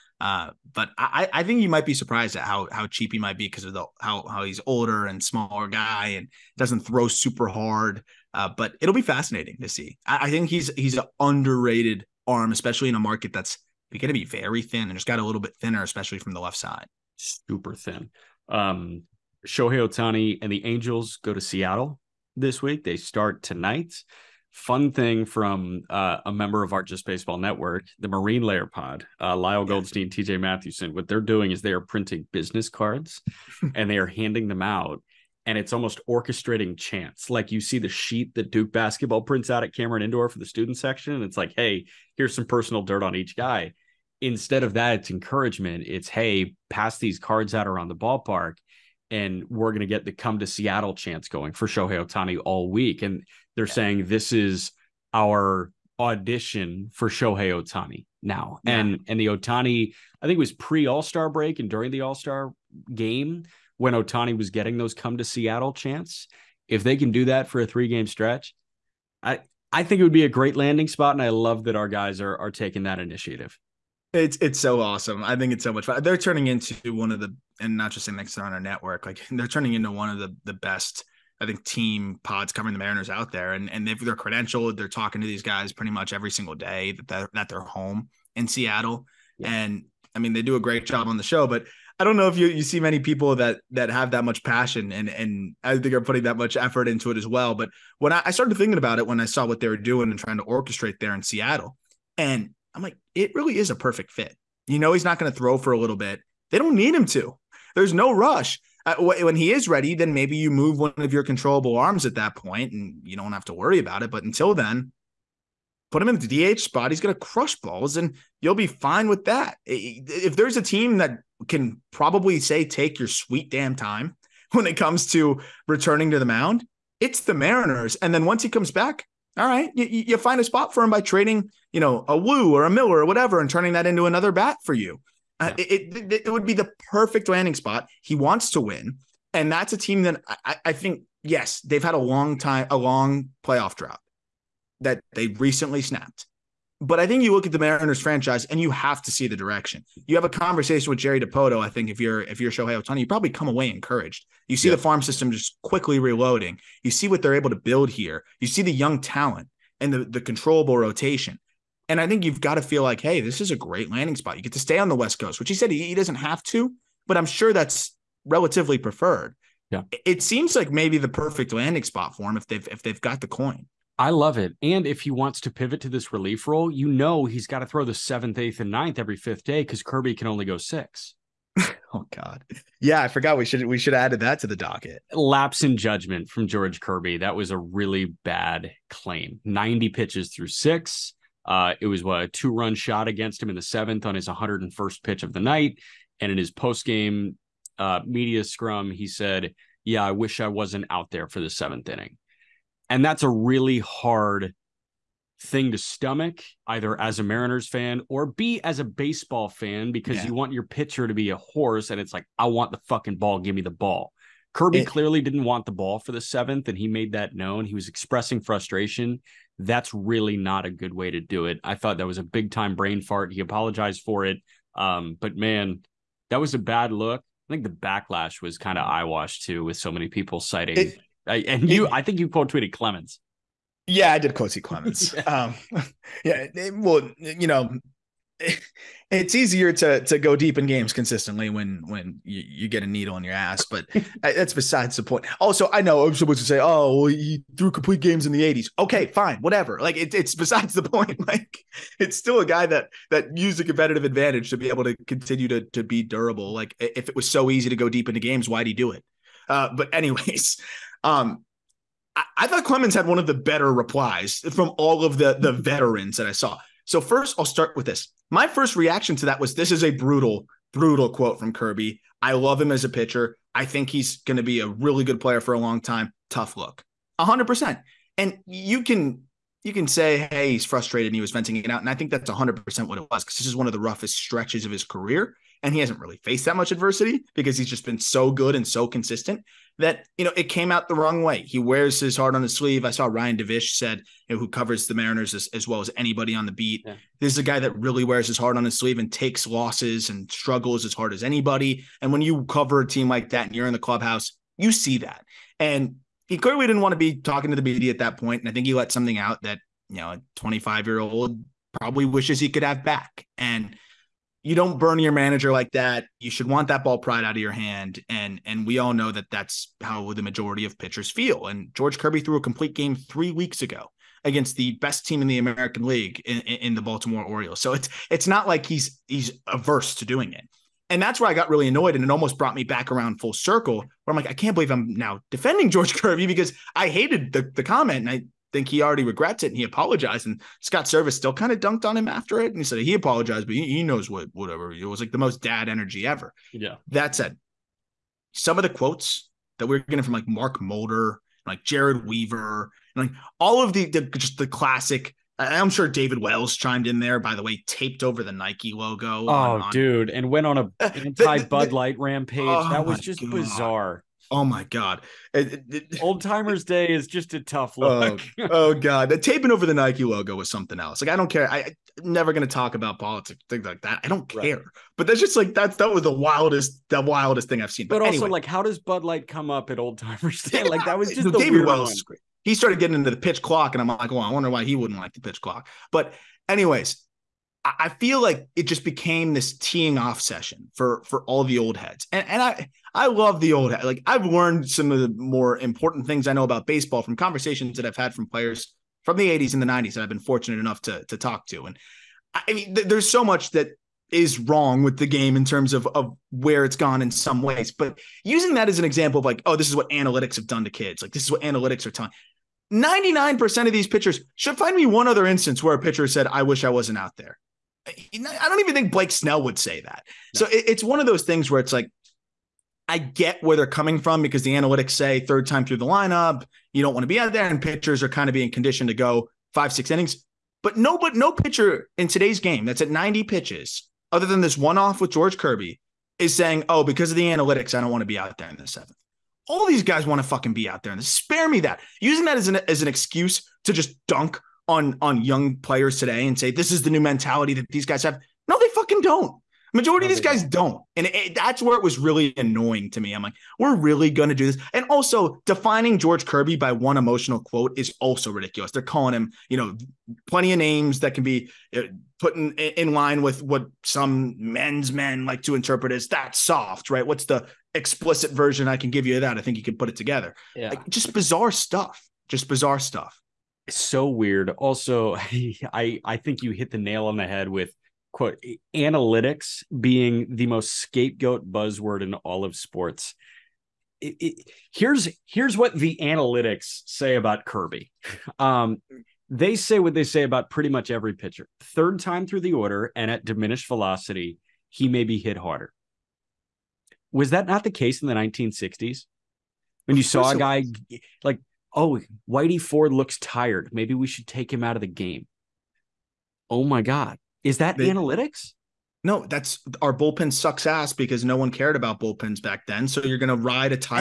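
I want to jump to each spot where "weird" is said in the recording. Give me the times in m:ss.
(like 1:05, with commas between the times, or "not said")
7:54.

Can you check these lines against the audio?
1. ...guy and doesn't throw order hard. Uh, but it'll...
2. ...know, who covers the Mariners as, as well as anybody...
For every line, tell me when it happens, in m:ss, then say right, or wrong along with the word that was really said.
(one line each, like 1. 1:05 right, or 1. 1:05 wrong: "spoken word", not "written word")
1. 0:05 wrong: "super", not "order"
2. 4:54 right.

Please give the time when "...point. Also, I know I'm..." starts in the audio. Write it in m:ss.
4:05.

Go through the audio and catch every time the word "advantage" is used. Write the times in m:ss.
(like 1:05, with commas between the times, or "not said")
4:14.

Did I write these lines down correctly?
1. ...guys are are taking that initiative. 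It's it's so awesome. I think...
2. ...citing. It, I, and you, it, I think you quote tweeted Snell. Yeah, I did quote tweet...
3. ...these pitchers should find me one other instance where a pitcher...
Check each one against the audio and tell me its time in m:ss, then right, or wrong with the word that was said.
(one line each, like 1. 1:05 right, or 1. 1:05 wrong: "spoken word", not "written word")
1. 1:11 right
2. 3:50 wrong: "Clemens", not "Snell"
3. 6:53 right.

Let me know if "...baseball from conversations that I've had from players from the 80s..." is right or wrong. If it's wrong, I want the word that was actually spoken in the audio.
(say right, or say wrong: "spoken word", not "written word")
right.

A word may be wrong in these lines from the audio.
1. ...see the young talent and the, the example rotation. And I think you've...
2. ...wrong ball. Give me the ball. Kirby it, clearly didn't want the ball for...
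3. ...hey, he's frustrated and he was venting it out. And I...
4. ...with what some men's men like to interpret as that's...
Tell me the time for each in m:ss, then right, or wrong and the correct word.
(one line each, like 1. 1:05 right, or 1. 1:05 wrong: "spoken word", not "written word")
1. 2:38 wrong: "controllable", not "example"
2. 3:32 wrong: "fucking", not "wrong"
3. 4:40 right
4. 7:43 right.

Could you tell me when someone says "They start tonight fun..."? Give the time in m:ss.
0:22.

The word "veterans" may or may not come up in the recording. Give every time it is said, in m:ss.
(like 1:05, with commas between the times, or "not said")
4:25.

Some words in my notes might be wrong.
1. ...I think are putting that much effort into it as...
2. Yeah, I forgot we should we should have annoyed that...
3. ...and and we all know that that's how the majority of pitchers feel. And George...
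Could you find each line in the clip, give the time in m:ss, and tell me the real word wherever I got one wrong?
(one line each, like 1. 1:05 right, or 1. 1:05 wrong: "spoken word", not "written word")
1. 1:35 right
2. 3:02 wrong: "added", not "annoyed"
3. 5:18 right.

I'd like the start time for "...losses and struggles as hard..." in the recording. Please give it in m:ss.
4:59.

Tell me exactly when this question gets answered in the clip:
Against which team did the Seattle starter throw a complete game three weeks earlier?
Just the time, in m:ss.
5:26.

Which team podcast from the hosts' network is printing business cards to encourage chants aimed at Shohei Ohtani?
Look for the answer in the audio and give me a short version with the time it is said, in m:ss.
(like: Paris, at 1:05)
Marine Layer Pod, at 0:27.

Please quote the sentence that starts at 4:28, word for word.
My first reaction to that was this is a brutal, brutal quote from Kirby.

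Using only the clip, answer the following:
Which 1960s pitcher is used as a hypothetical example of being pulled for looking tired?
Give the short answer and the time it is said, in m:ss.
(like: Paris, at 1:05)
Whitey Ford, at 8:22.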